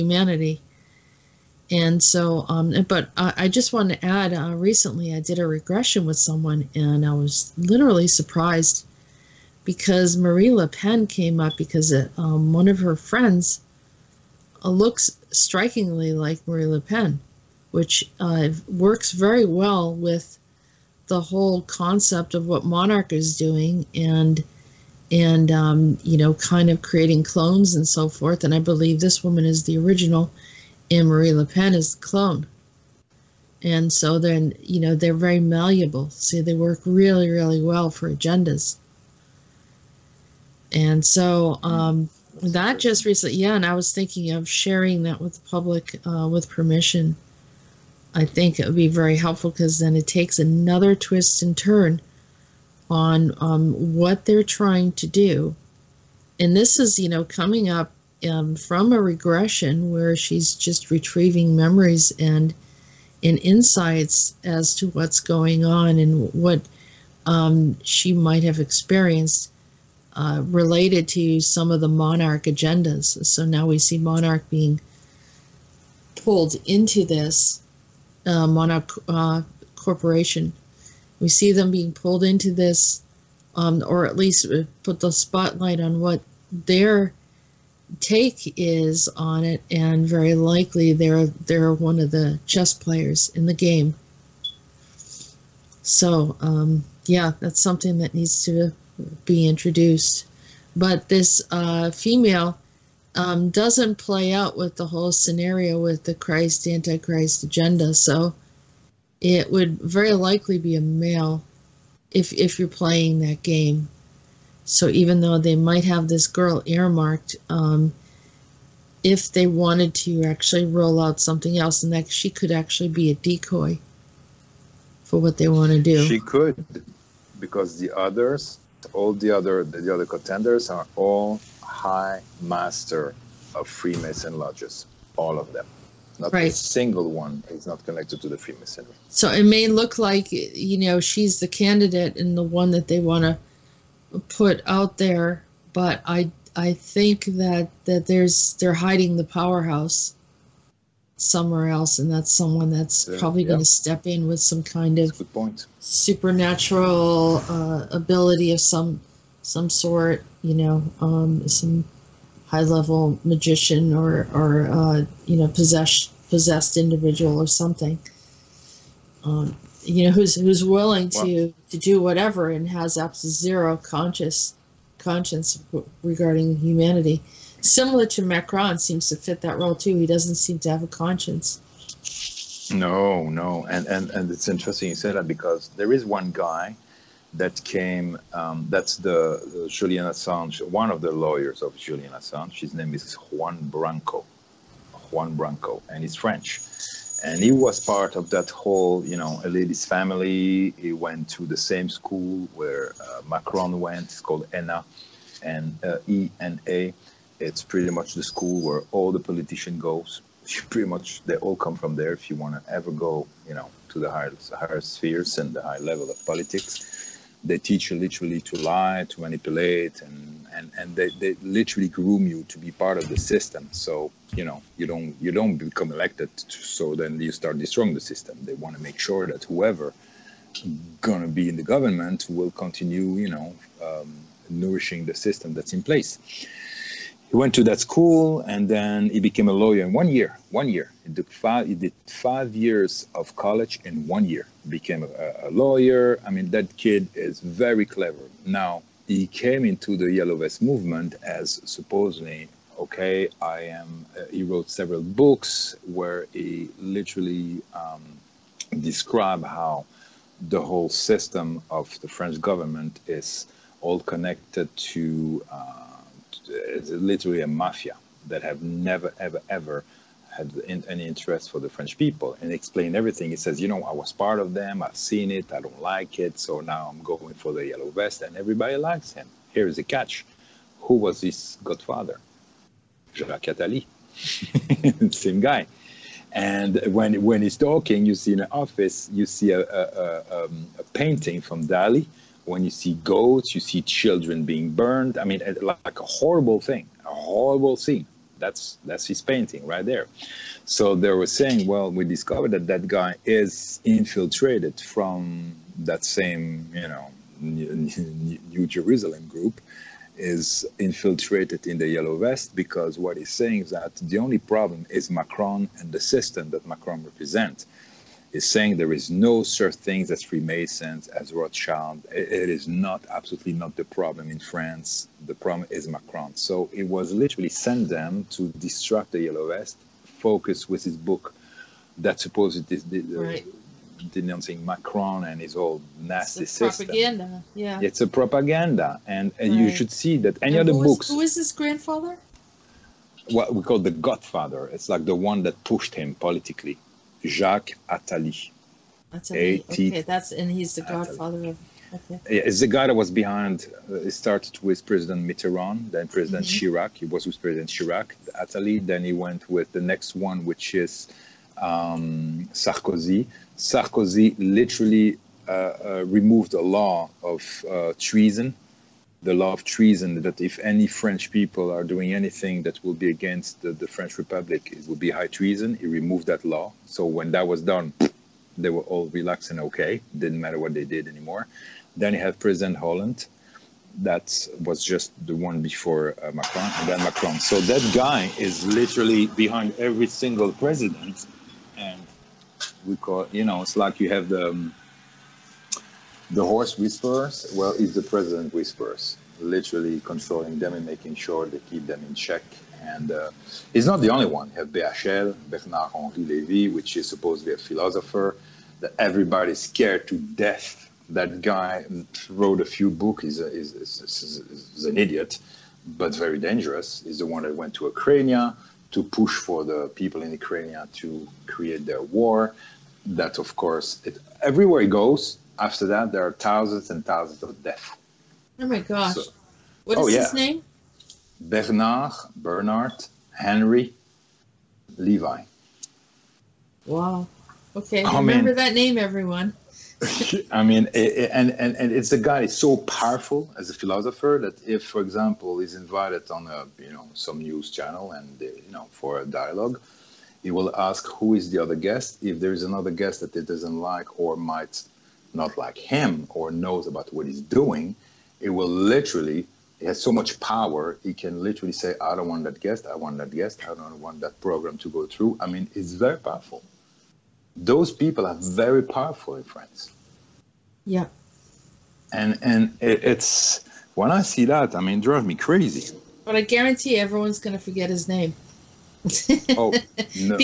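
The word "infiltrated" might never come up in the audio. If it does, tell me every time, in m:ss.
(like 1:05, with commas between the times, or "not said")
5:03, 5:10.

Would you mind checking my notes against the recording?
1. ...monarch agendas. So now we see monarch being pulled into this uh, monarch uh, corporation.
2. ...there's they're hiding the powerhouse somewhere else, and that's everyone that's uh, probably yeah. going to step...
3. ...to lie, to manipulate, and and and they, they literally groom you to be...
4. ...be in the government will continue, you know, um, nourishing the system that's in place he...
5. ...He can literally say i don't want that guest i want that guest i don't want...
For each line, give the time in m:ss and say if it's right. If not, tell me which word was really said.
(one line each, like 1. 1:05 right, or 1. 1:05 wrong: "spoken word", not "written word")
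1. 1:11 right
2. 2:28 wrong: "someone", not "everyone"
3. 3:38 right
4. 3:51 right
5. 7:41 right.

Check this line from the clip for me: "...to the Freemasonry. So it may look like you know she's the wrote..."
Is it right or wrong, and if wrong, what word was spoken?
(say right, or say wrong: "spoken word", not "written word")
wrong: "candidate", not "wrote".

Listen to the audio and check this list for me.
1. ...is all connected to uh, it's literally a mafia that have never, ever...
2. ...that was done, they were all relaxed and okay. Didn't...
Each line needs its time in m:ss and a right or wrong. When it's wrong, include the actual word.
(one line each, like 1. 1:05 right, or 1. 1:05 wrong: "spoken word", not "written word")
1. 4:23 right
2. 6:17 right.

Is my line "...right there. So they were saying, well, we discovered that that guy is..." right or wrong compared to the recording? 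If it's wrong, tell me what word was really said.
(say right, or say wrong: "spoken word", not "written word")
right.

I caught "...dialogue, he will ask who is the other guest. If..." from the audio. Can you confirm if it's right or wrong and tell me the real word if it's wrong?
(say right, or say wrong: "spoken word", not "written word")
right.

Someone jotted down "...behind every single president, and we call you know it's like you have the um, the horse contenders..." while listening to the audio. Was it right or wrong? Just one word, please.
wrong.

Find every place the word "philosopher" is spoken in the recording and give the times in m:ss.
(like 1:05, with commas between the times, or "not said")
6:47, 7:23.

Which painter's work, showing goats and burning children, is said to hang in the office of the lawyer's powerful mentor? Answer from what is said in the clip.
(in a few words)
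Dali.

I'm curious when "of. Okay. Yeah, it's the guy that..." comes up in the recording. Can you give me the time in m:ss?
5:51.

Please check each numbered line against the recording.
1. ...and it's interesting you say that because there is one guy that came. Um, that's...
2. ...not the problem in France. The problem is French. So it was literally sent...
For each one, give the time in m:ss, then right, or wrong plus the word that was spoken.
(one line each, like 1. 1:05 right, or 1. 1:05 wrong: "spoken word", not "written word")
1. 3:04 right
2. 5:23 wrong: "Macron", not "French".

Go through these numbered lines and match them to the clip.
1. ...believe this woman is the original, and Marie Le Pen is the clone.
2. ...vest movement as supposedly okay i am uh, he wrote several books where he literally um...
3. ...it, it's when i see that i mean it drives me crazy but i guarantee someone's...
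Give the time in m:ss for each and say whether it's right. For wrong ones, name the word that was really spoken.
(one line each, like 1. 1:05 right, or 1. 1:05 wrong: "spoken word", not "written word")
1. 0:28 right
2. 4:10 right
3. 7:52 wrong: "everyone", not "someone".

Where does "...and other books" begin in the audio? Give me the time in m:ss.
5:40.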